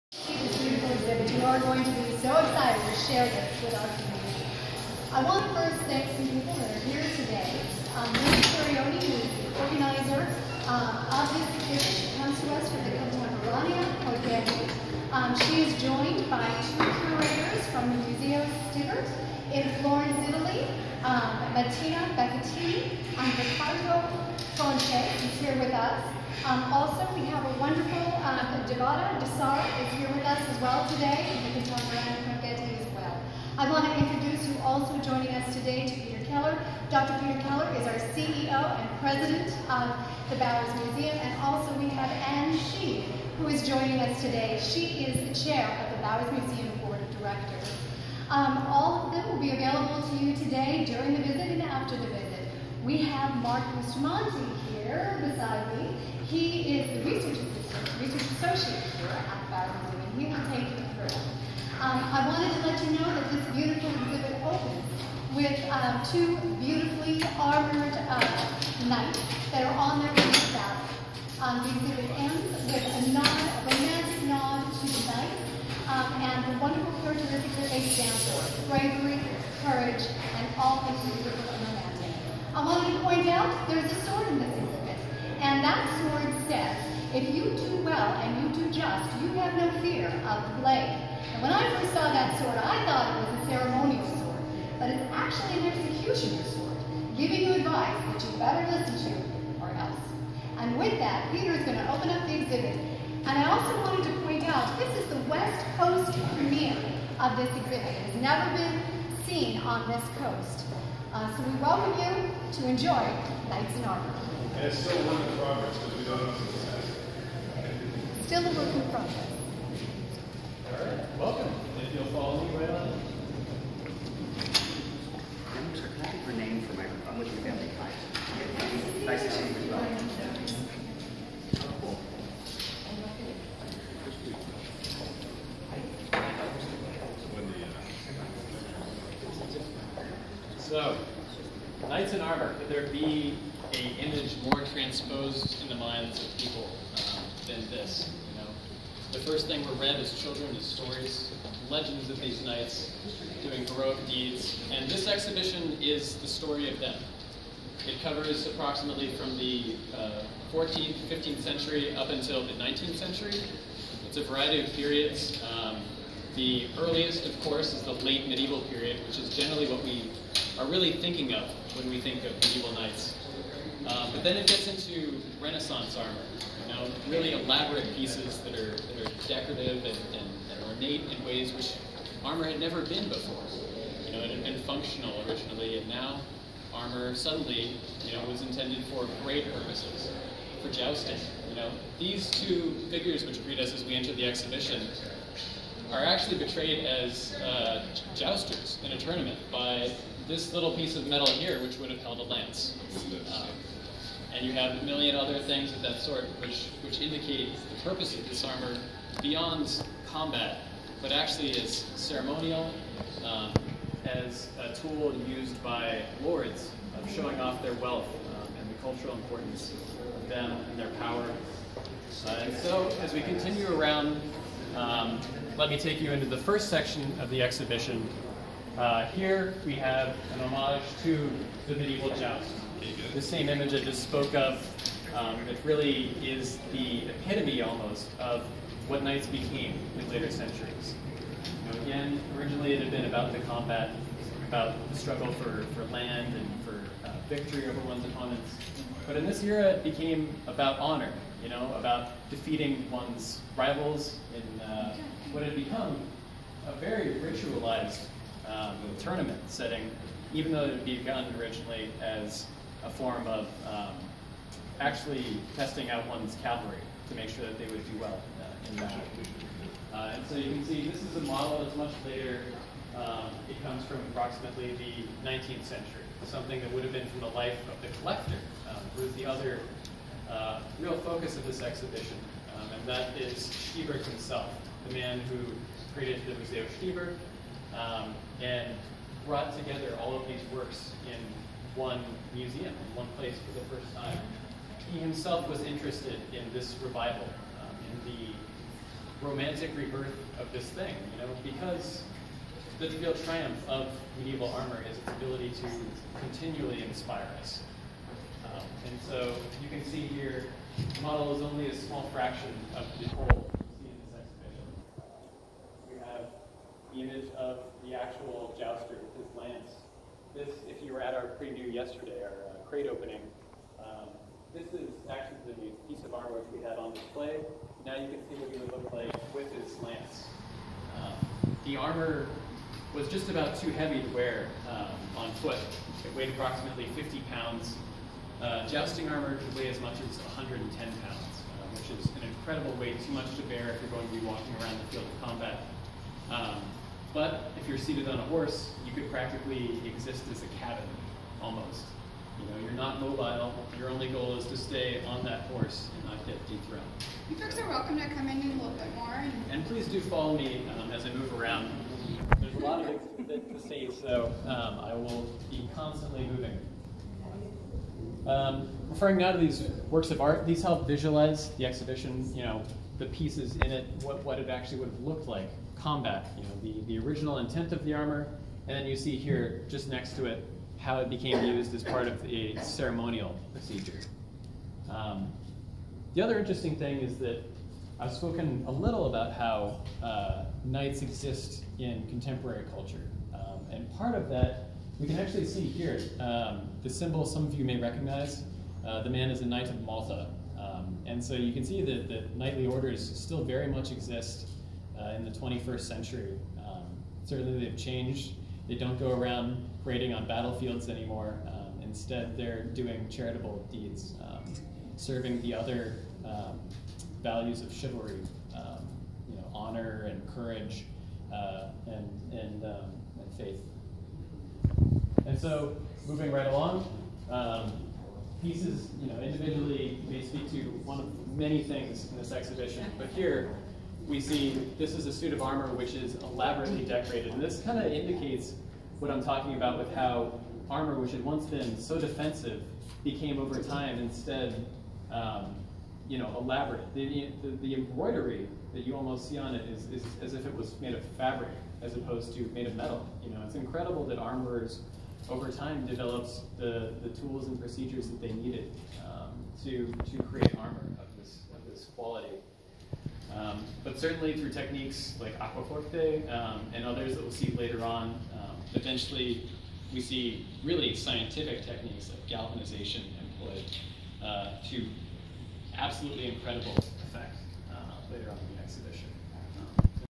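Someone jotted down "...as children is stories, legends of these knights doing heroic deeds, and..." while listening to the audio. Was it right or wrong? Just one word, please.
right.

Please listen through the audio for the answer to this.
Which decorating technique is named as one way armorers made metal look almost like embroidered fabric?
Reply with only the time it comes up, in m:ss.
7:45.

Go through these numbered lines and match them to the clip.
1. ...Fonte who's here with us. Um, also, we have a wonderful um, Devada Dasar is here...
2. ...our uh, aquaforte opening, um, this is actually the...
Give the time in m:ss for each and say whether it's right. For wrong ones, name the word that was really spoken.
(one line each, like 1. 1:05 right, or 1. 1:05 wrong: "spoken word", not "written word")
1. 0:24 right
2. 5:22 wrong: "crate", not "aquaforte".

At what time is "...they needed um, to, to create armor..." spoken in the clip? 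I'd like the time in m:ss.
7:38.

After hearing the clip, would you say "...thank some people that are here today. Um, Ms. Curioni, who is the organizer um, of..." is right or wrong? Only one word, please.
right.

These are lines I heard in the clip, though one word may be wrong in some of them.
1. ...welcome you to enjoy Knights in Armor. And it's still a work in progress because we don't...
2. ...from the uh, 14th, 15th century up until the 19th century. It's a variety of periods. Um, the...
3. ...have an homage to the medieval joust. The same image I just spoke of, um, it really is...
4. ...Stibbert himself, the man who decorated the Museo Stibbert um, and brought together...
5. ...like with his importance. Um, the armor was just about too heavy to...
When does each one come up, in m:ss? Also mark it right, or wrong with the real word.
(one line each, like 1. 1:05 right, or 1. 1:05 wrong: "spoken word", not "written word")
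1. 1:51 right
2. 2:39 right
3. 3:49 right
4. 4:43 wrong: "created", not "decorated"
5. 5:28 wrong: "lance", not "importance".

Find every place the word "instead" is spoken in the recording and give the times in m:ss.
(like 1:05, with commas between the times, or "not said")
6:51, 7:23.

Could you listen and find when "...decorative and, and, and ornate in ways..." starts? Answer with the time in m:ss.
2:59.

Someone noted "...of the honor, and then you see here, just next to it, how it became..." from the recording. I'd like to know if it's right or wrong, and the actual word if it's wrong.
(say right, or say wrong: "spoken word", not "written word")
wrong: "armor", not "honor".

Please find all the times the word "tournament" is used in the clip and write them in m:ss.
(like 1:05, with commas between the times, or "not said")
3:18, 4:18.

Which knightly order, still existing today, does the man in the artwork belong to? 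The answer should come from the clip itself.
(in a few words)
Knight of Malta.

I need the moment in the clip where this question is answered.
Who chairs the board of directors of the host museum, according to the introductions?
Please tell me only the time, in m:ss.
0:42.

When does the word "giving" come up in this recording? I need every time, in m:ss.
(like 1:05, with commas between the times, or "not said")
1:37.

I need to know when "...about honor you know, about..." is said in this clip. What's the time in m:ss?
4:10.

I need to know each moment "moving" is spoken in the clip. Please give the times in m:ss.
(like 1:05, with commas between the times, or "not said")
6:06, 7:06.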